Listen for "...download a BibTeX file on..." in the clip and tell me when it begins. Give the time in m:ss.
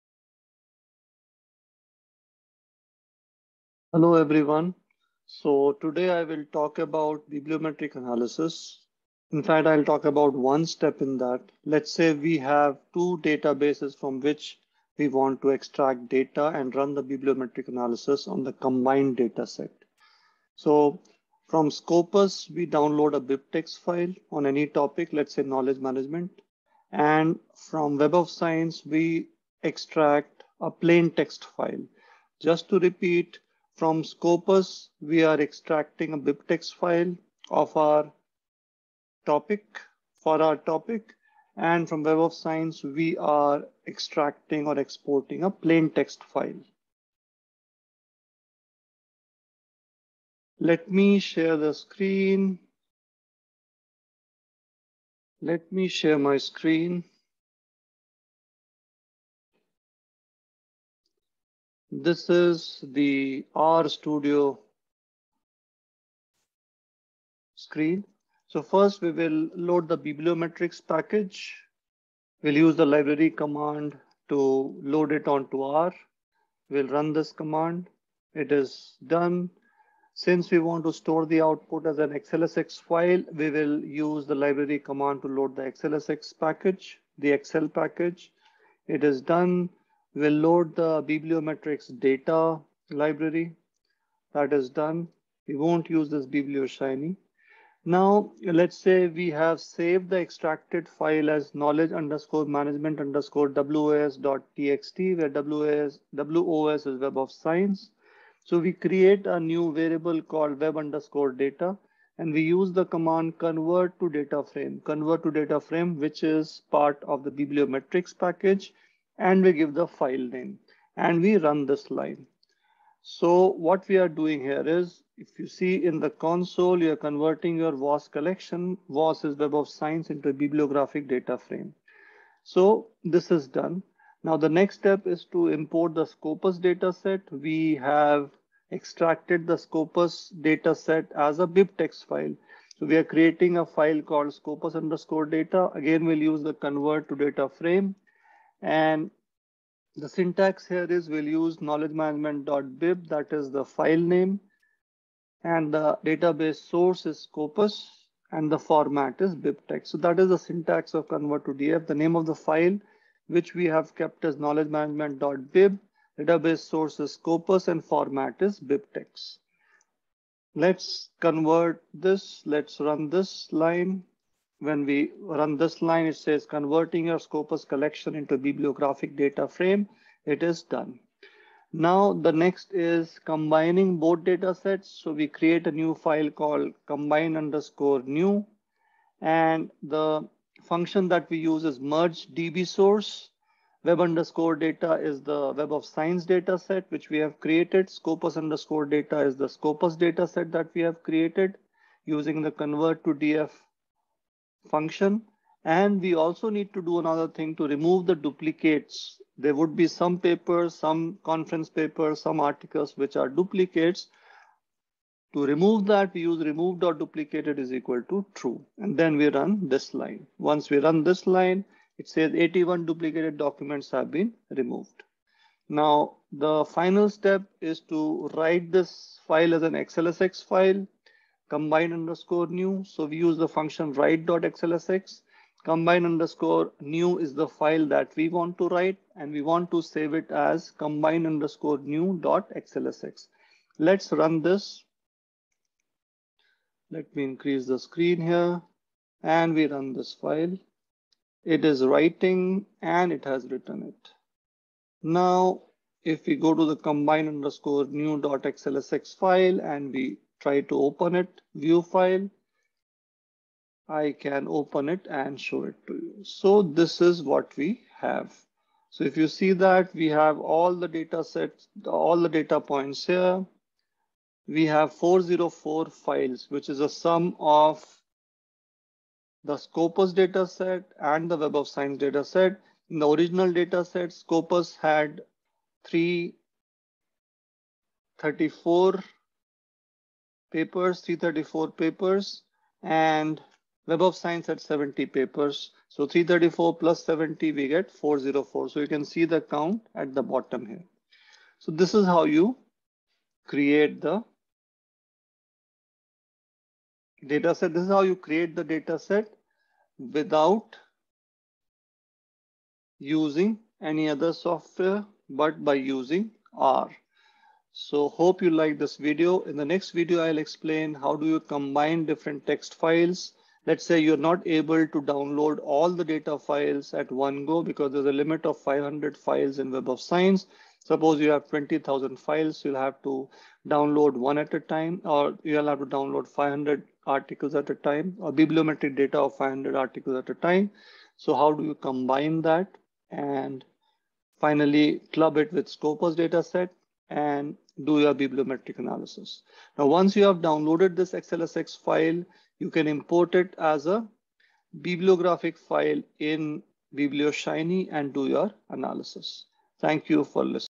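0:22.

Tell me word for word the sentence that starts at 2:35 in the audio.
And the database source is Scopus and the format is BibTeX.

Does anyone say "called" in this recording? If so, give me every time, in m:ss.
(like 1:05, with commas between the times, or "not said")
1:50, 2:24, 3:06.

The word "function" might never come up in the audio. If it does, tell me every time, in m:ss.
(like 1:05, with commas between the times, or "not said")
3:10, 3:24, 3:53.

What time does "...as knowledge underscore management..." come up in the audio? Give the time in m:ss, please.
1:41.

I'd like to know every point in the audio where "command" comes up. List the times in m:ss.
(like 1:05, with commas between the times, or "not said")
1:13, 1:17, 1:24, 1:52.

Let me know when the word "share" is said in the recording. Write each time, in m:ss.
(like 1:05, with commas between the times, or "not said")
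0:51, 0:55.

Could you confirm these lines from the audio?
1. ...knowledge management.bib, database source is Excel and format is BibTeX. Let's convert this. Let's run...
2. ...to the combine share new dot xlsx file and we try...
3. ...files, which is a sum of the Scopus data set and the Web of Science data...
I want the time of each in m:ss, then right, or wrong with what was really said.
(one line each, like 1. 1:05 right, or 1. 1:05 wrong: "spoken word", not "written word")
1. 2:44 wrong: "Scopus", not "Excel"
2. 4:16 wrong: "underscore", not "share"
3. 4:35 right.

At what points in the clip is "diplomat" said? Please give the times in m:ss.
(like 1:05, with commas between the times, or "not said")
not said.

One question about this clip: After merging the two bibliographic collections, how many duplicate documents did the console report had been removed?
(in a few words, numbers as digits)
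81.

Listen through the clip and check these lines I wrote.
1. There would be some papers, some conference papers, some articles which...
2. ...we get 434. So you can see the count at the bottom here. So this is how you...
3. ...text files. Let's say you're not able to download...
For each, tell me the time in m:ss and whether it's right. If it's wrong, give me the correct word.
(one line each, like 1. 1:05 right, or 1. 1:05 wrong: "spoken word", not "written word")
1. 3:29 right
2. 4:57 wrong: "404", not "434"
3. 5:22 right.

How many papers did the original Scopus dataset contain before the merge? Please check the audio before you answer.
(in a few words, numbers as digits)
334.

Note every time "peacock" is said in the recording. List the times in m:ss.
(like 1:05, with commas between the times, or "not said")
not said.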